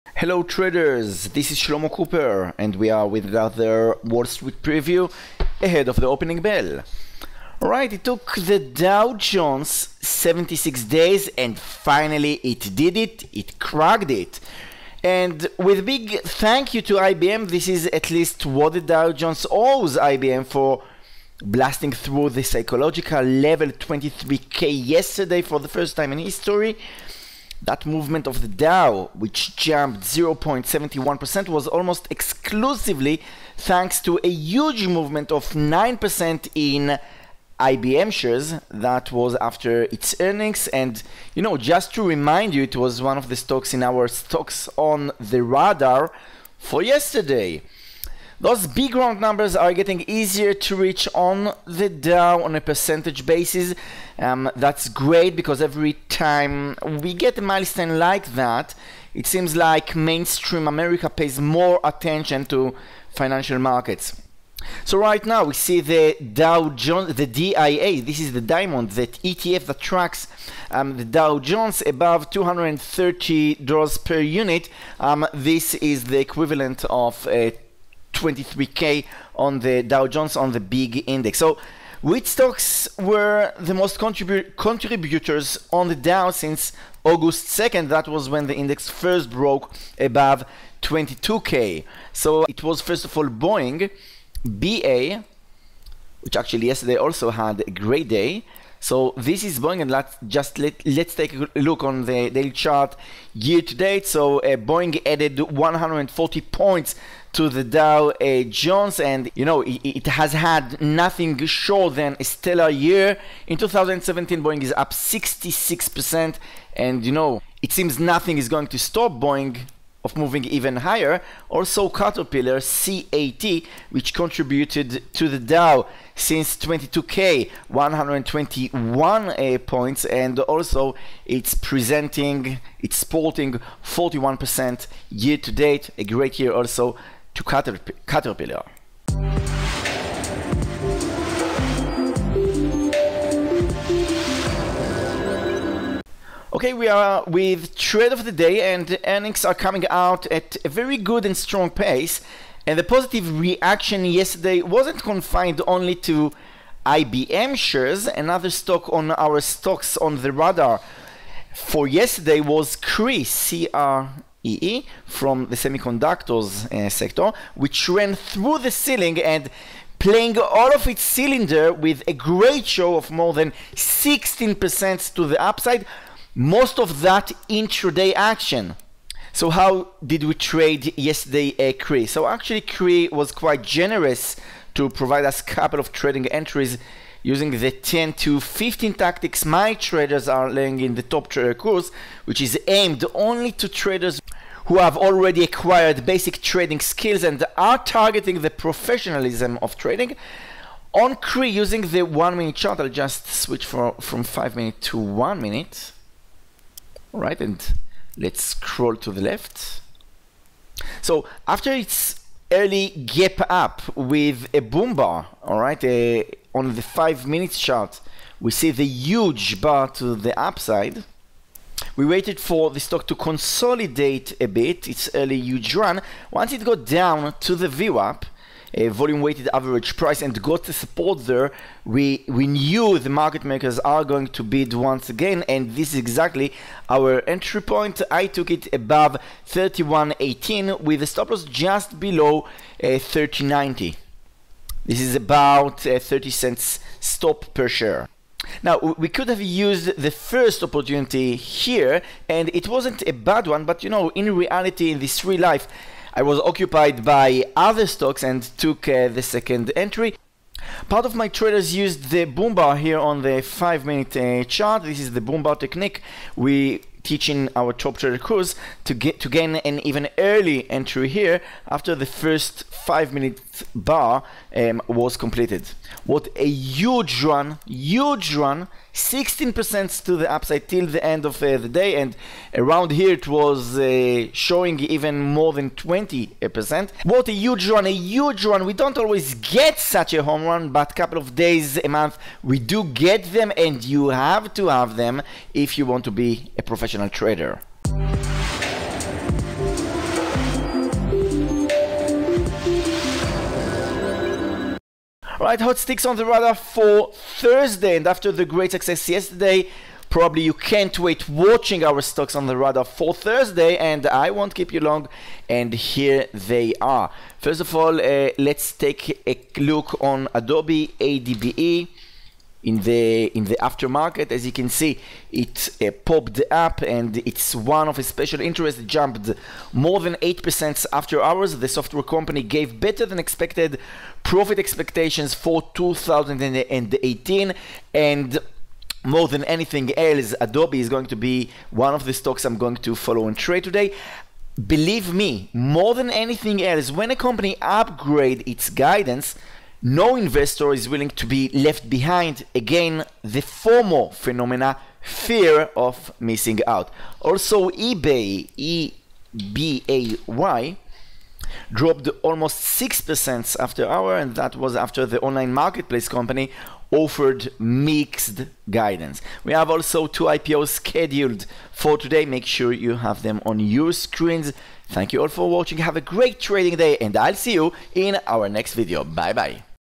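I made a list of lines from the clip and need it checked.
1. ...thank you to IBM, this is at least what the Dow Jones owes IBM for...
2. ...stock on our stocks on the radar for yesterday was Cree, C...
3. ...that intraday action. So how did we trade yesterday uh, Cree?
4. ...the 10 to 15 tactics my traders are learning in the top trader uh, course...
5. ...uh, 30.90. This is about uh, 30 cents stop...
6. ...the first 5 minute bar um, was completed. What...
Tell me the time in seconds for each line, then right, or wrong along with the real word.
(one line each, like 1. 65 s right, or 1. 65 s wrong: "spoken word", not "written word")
1. 16 s right
2. 158 s right
3. 177 s right
4. 187 s right
5. 242 s right
6. 271 s right.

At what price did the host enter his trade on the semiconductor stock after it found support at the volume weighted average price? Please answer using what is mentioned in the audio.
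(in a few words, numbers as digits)
31.18.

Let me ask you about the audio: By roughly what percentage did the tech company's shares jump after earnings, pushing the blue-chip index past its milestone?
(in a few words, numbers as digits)
9%.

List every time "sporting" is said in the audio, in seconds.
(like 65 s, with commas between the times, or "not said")
132 s.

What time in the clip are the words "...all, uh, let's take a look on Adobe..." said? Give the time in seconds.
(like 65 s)
317 s.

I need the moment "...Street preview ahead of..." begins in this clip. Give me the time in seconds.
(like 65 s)
4 s.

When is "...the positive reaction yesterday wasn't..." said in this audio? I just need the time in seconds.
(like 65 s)
152 s.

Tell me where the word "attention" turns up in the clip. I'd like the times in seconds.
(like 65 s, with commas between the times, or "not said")
61 s.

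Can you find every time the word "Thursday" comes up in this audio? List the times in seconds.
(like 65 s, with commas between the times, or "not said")
307 s, 313 s.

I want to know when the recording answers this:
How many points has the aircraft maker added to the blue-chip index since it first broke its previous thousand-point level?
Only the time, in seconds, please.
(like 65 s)
105 s.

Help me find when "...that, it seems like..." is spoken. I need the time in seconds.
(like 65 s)
58 s.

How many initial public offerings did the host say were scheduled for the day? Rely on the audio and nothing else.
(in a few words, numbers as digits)
2.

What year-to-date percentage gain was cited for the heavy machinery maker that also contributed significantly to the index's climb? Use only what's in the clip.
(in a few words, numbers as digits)
41%.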